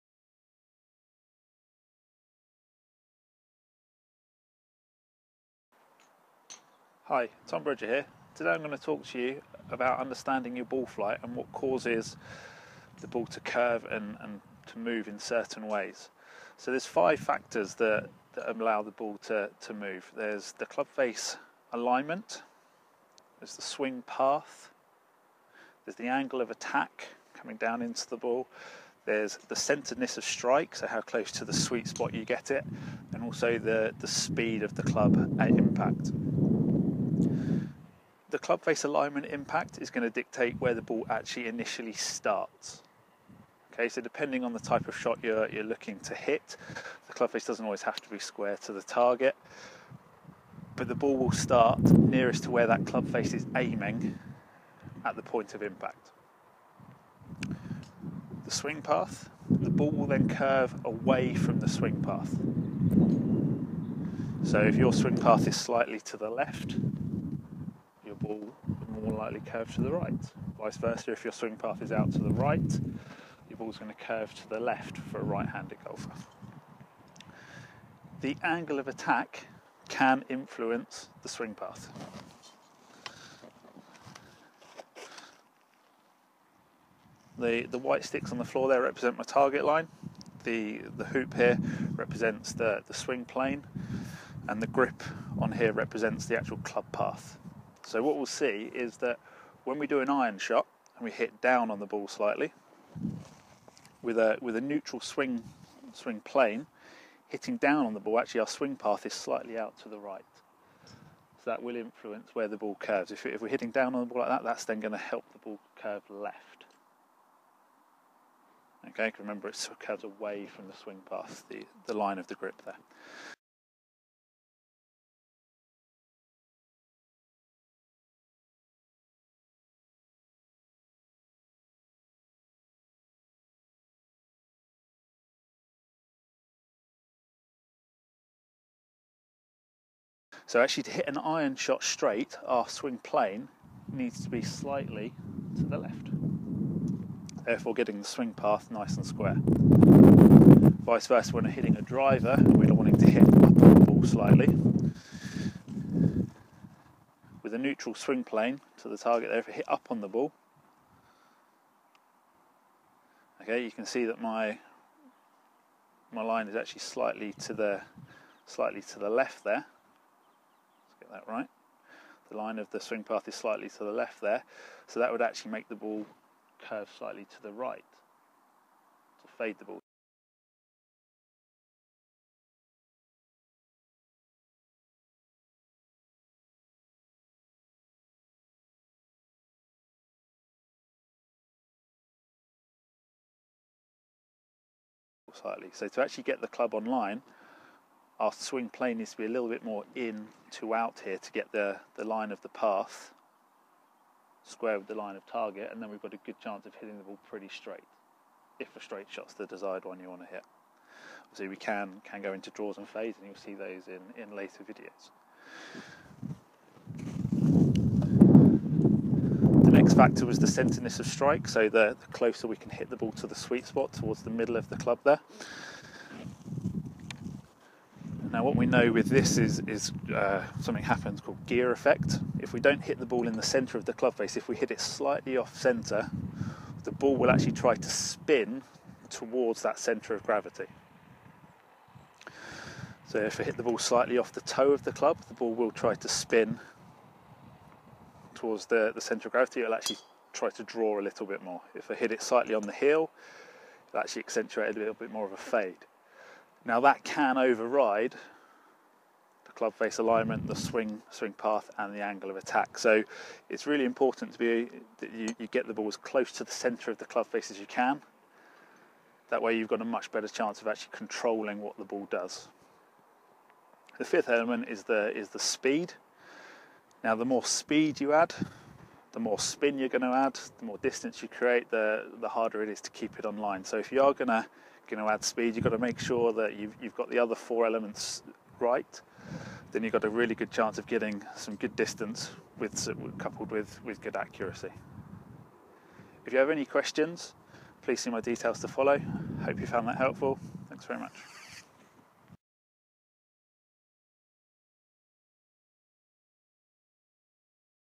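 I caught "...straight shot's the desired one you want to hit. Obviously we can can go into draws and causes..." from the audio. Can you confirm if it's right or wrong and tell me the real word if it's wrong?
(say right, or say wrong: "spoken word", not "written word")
wrong: "fades", not "causes".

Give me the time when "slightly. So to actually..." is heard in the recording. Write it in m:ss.
3:15.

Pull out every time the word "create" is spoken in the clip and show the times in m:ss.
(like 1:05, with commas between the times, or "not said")
4:41.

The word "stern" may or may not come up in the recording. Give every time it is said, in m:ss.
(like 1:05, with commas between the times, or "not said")
not said.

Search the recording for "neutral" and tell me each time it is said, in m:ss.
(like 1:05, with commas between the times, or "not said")
1:44, 2:37.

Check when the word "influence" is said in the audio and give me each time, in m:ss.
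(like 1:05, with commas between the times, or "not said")
1:20, 1:51.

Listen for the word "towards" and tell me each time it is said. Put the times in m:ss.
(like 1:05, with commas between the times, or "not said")
3:43, 3:59, 4:08.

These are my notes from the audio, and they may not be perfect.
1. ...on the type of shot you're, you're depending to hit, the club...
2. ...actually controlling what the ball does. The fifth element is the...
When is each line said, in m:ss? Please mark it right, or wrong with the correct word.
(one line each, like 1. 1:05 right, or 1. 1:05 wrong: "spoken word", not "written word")
1. 0:44 wrong: "looking", not "depending"
2. 4:30 right.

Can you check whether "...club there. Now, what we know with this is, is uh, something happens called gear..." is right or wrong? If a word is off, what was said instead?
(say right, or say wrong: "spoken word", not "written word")
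right.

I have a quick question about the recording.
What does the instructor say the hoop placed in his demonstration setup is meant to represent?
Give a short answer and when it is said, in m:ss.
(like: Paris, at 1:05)
the swing plane, at 1:32.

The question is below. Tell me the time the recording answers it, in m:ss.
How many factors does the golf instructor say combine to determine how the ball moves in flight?
0:16.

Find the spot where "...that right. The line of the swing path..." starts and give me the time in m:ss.
2:51.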